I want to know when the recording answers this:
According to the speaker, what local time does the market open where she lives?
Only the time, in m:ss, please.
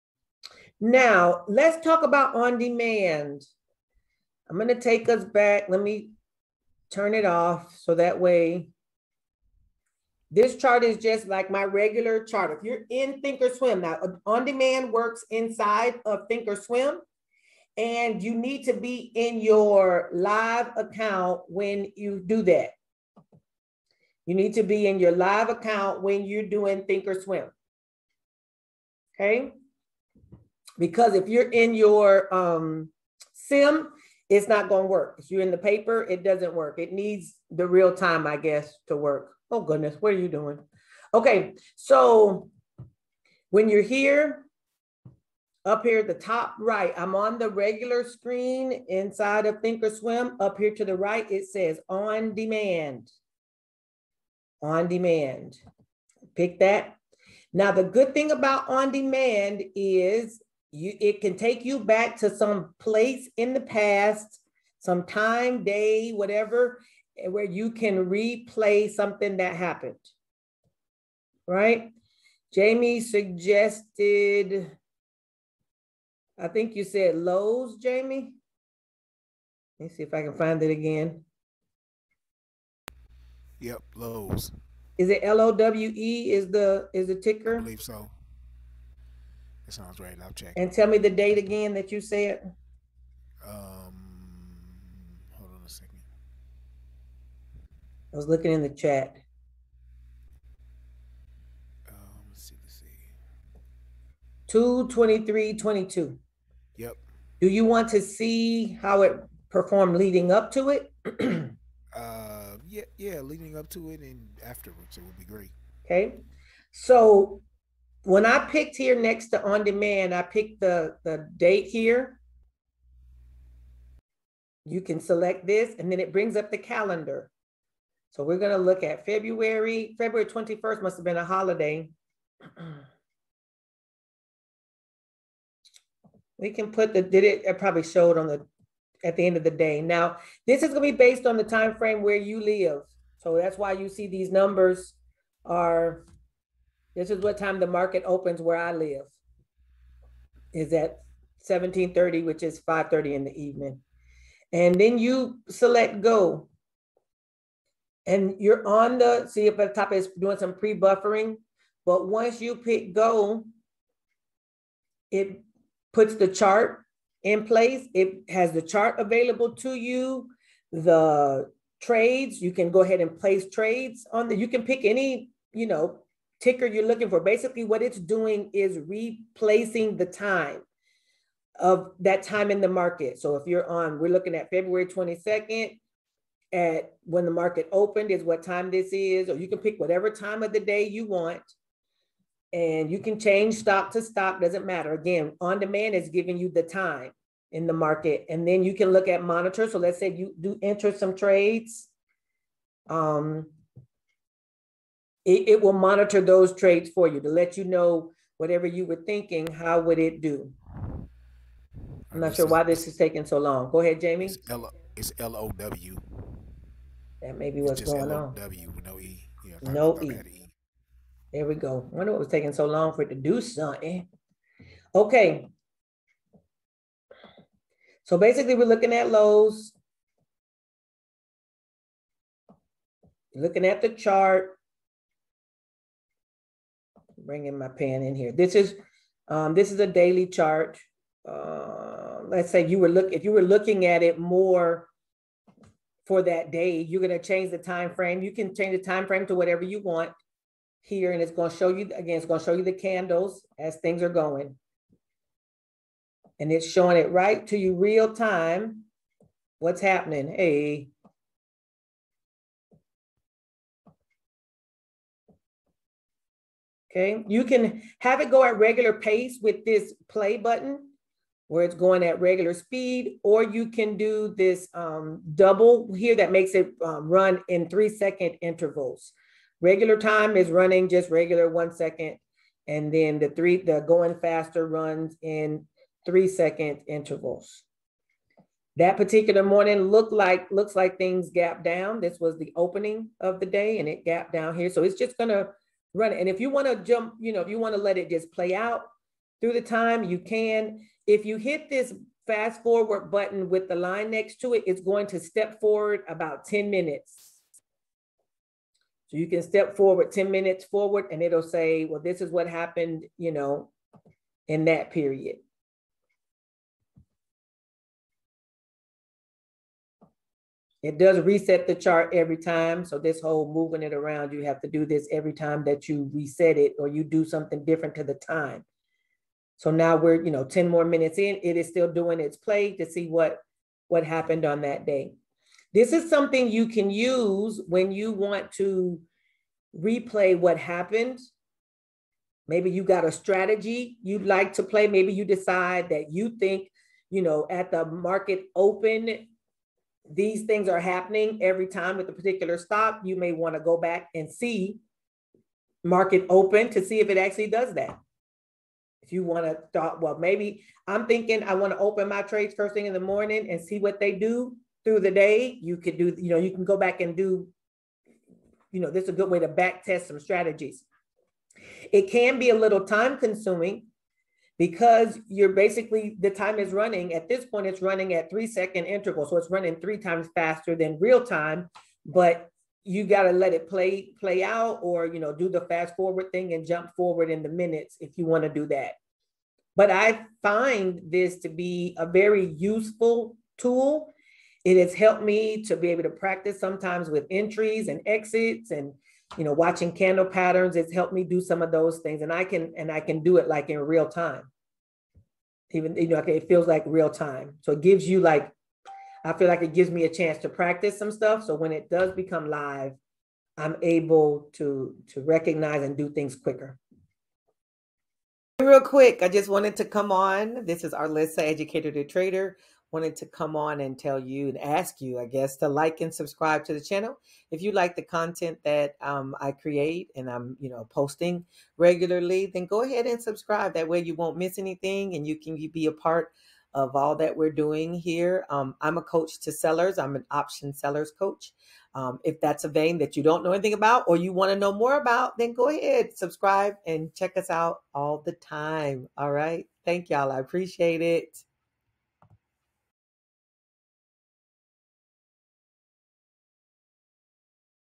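2:31.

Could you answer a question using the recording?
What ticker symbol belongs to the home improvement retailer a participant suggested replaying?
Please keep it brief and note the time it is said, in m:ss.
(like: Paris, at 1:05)
LOW, at 3:38.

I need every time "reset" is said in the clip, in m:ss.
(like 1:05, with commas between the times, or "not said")
5:21, 5:26.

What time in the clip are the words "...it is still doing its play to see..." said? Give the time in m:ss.
5:31.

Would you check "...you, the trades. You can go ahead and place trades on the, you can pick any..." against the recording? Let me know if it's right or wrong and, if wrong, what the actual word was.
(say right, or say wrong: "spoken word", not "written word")
right.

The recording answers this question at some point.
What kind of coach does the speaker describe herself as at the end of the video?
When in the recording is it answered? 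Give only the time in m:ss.
7:20.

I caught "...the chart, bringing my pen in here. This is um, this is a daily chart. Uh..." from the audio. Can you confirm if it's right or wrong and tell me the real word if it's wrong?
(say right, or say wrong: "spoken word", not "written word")
right.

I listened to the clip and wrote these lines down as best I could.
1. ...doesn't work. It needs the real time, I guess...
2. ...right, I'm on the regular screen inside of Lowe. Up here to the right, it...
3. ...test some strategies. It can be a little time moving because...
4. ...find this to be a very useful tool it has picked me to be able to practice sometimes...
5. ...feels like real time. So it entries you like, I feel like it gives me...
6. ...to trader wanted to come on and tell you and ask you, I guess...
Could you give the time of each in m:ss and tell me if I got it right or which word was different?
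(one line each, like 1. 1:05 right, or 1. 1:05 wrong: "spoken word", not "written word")
1. 0:36 right
2. 0:46 wrong: "Thinkorswim", not "Lowe"
3. 6:09 wrong: "consuming", not "moving"
4. 6:30 wrong: "helped", not "picked"
5. 6:46 wrong: "gives", not "entries"
6. 7:01 right.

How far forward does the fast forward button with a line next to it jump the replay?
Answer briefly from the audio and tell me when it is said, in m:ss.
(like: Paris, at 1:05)
10 minutes, at 5:06.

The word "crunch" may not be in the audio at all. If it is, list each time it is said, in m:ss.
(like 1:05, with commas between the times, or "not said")
not said.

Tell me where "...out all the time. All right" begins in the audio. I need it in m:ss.
7:27.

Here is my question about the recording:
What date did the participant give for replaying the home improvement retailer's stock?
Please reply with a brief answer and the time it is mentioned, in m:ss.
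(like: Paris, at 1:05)
2/23/22, at 1:44.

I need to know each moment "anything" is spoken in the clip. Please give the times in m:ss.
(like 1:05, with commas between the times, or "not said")
7:14, 7:23.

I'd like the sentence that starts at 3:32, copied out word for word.
I'm not this sure is, why this is taking so long.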